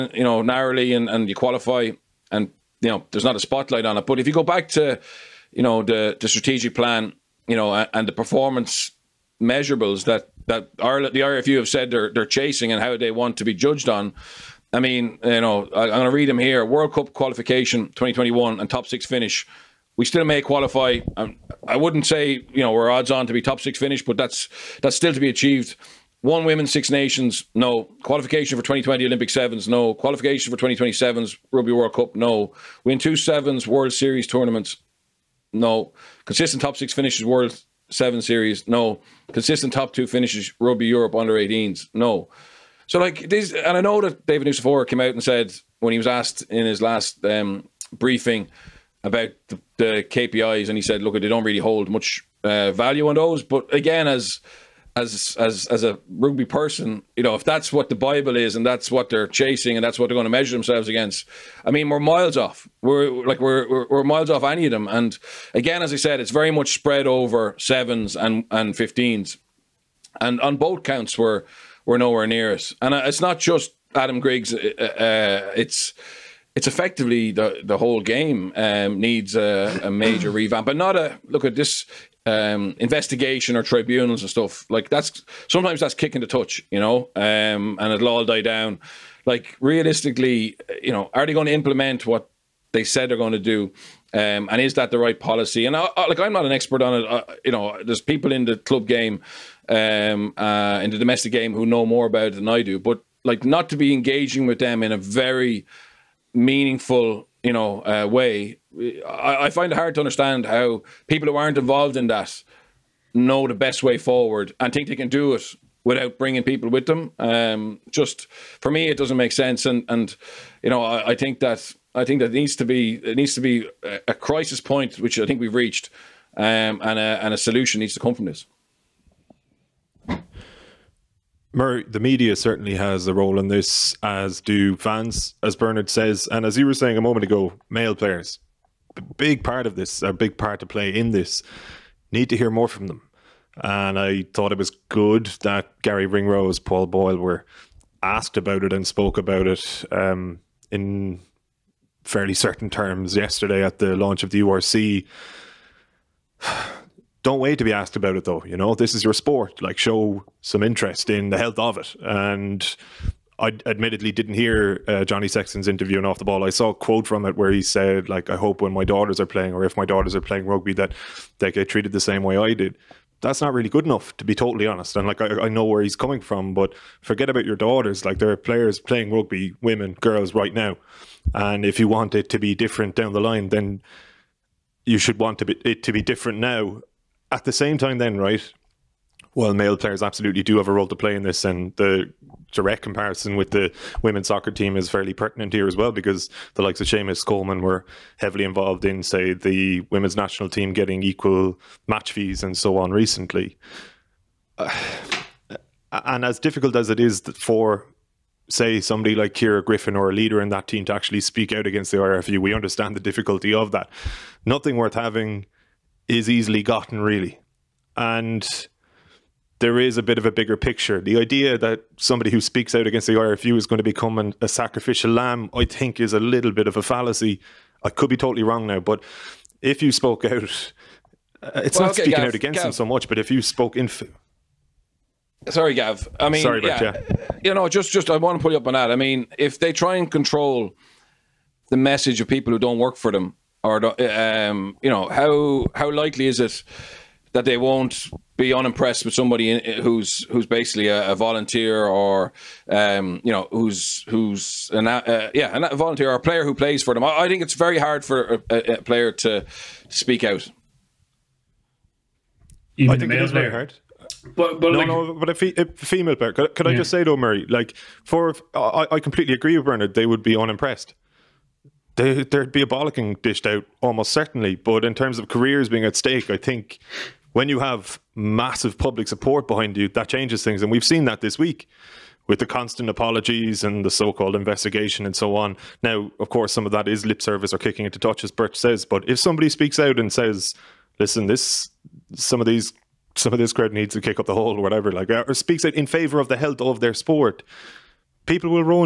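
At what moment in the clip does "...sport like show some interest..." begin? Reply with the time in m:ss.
2:39.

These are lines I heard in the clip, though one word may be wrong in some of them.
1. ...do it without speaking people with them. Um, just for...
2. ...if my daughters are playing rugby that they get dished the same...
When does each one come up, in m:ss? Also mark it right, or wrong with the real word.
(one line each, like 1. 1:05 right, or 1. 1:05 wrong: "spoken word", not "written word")
1. 1:55 wrong: "bringing", not "speaking"
2. 2:49 wrong: "treated", not "dished".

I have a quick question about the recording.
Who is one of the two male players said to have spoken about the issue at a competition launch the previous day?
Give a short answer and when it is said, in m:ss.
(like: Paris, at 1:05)
Garry Ringrose, at 2:25.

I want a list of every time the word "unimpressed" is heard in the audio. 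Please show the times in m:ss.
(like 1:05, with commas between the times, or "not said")
4:08, 4:30.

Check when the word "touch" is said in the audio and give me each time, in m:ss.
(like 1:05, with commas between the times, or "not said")
1:26, 4:47.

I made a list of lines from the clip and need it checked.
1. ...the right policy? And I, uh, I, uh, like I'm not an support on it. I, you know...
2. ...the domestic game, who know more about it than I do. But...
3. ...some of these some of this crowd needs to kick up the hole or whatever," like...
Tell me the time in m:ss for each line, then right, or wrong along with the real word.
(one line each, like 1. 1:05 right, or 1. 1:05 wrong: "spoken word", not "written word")
1. 1:34 wrong: "expert", not "support"
2. 1:40 right
3. 4:52 right.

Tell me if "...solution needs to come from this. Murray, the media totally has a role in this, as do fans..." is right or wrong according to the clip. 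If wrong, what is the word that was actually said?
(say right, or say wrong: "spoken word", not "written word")
wrong: "certainly", not "totally".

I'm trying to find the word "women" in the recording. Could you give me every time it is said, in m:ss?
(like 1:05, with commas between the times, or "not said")
0:26, 2:59, 3:14, 3:19.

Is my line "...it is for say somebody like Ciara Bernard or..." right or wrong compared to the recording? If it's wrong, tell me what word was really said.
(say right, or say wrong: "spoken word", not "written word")
wrong: "Griffin", not "Bernard".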